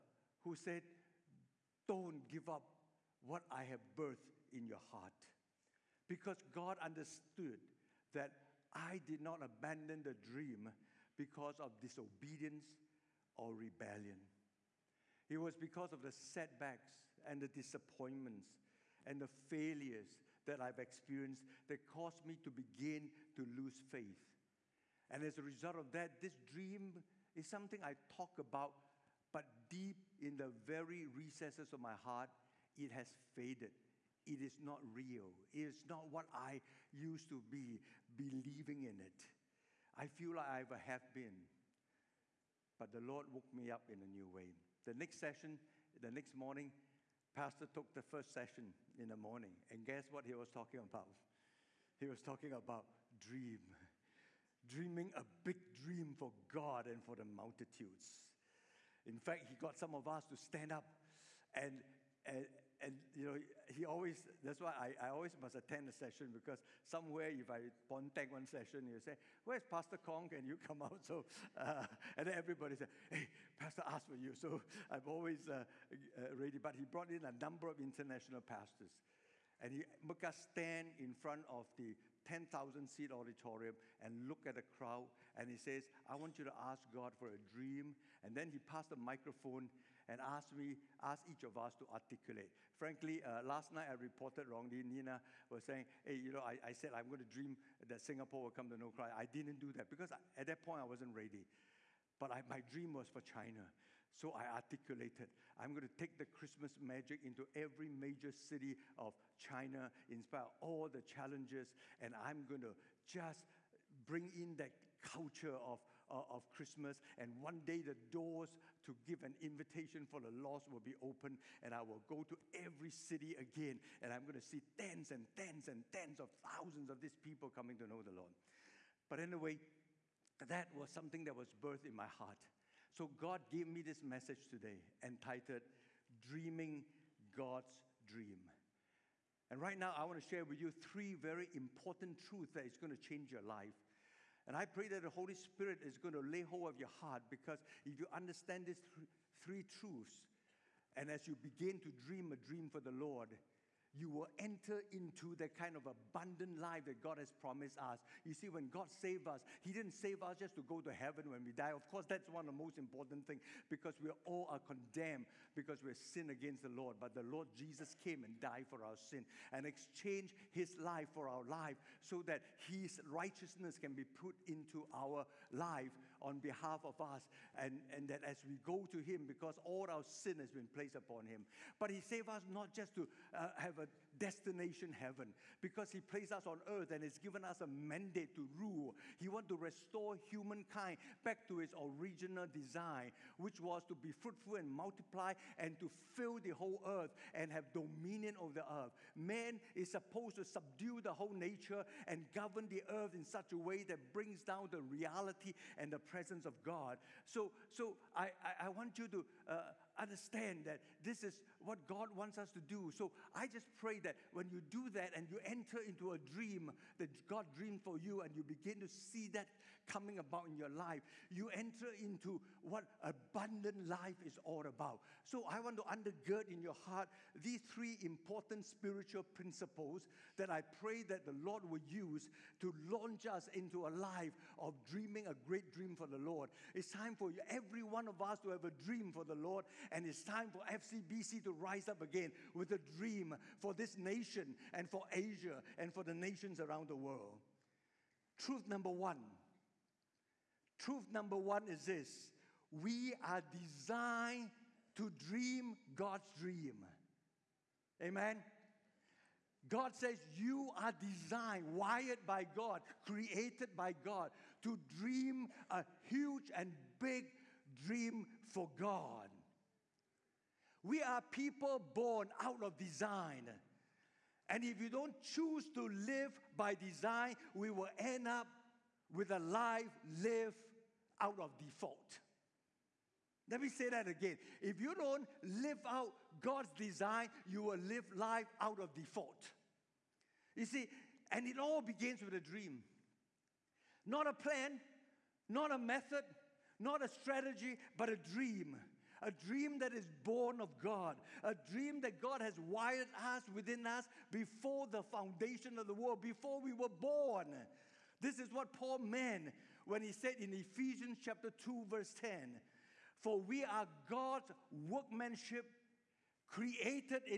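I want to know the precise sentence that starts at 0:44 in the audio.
The next session, the next morning, Pastor took the first session in the morning.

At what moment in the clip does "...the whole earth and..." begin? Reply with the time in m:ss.
3:16.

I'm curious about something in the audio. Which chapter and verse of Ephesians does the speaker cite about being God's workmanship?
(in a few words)
Chapter 2 verse 10.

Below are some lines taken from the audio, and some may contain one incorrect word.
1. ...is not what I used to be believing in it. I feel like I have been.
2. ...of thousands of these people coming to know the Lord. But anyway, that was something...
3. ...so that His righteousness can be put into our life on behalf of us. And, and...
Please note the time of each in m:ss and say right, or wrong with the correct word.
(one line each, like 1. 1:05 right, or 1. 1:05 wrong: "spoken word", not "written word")
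1. 0:35 right
2. 2:06 right
3. 2:52 right.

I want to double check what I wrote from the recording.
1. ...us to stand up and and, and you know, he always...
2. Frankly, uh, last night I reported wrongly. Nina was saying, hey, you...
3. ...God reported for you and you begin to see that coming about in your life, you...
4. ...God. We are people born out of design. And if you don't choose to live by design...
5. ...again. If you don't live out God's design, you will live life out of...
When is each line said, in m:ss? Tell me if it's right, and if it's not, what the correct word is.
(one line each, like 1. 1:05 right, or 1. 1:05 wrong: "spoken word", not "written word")
1. 1:00 right
2. 1:32 right
3. 3:37 wrong: "dreamed", not "reported"
4. 4:28 right
5. 4:44 right.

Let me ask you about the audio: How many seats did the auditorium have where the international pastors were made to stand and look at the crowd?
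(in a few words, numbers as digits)
10,000.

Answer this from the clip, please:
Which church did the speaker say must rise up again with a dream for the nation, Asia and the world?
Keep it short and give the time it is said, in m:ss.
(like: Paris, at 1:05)
FCBC, at 4:00.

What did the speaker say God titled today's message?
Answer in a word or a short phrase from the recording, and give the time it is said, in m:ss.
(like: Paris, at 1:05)
Dreaming God's Dream, at 2:16.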